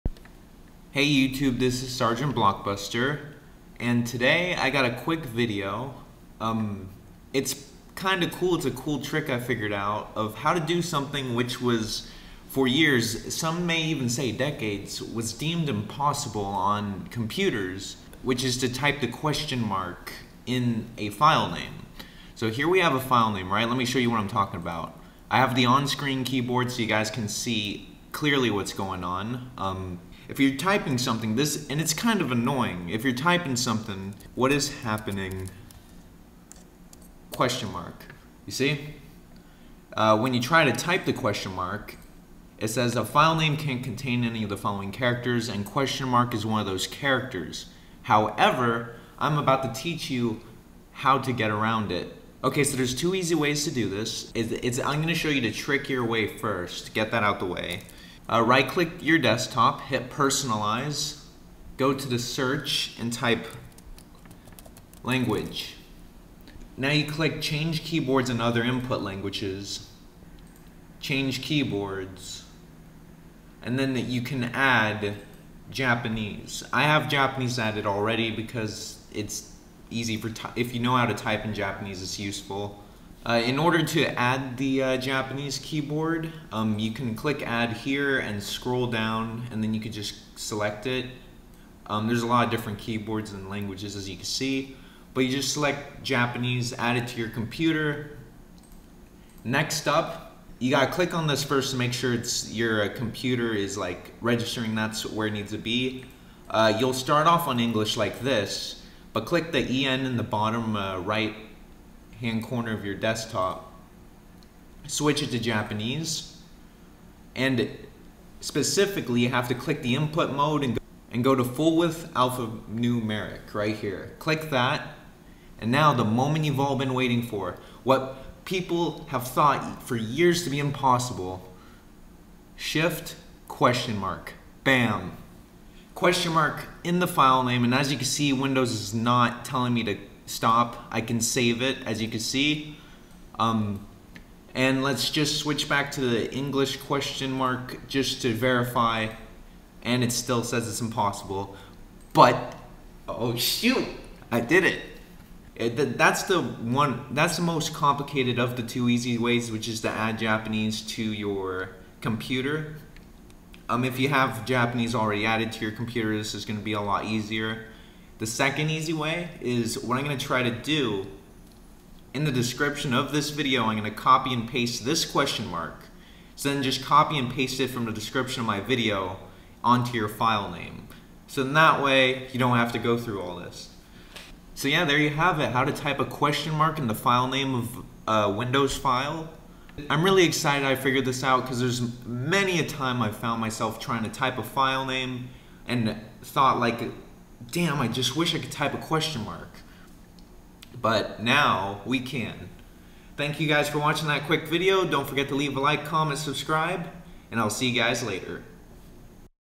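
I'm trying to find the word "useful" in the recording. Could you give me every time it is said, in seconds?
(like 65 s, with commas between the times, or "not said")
82 s.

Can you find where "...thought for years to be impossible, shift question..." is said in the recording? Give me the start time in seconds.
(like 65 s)
129 s.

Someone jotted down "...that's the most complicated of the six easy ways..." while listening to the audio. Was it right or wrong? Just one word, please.
wrong.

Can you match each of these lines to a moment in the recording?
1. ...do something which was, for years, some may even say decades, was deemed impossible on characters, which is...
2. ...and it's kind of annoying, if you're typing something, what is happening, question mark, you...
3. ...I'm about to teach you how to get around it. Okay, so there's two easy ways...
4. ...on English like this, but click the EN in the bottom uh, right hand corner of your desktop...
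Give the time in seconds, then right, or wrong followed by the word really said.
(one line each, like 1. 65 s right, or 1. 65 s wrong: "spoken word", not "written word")
1. 10 s wrong: "computers", not "characters"
2. 31 s right
3. 49 s right
4. 107 s right.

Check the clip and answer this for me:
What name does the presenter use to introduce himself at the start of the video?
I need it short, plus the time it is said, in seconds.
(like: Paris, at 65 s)
Sergeant Blockbuster, at 1 s.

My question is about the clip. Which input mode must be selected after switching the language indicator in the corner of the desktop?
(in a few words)
full width alphanumeric.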